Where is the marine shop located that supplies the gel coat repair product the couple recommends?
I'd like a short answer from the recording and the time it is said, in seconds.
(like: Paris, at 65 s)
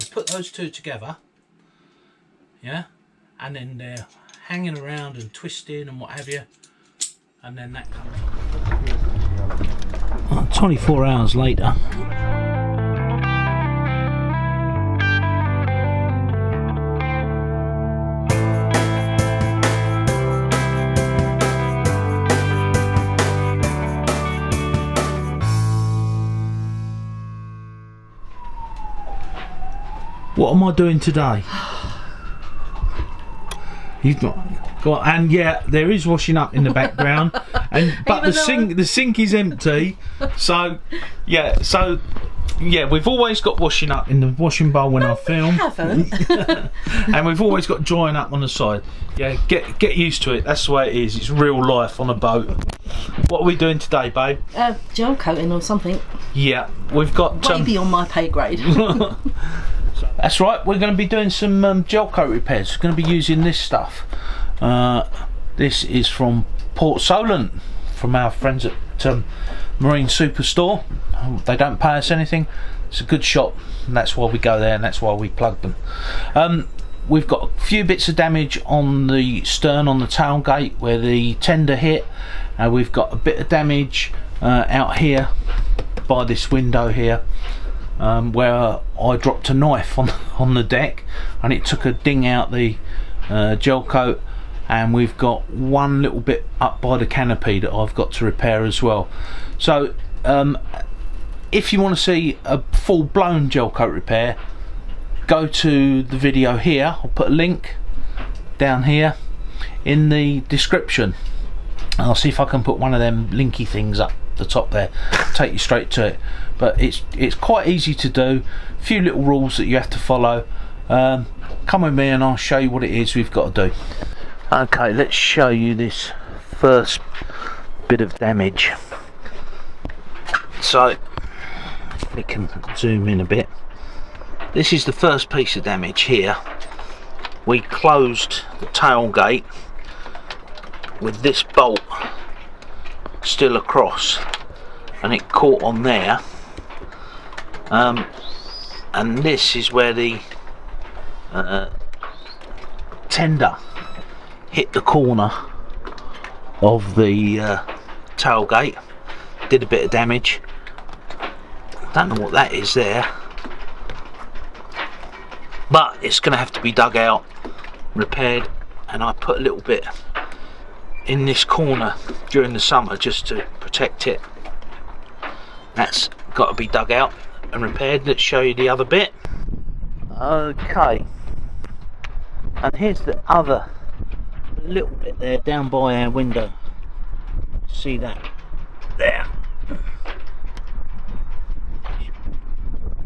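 Port Solent, at 66 s.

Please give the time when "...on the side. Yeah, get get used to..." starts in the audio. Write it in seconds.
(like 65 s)
48 s.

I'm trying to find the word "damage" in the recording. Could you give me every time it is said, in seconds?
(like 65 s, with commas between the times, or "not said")
78 s, 83 s, 128 s, 135 s, 159 s.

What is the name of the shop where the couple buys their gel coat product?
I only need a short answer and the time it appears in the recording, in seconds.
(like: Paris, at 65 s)
Marine Superstore, at 69 s.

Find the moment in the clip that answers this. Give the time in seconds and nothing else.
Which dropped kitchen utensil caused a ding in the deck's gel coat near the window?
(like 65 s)
89 s.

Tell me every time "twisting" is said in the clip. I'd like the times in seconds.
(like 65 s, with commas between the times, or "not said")
5 s.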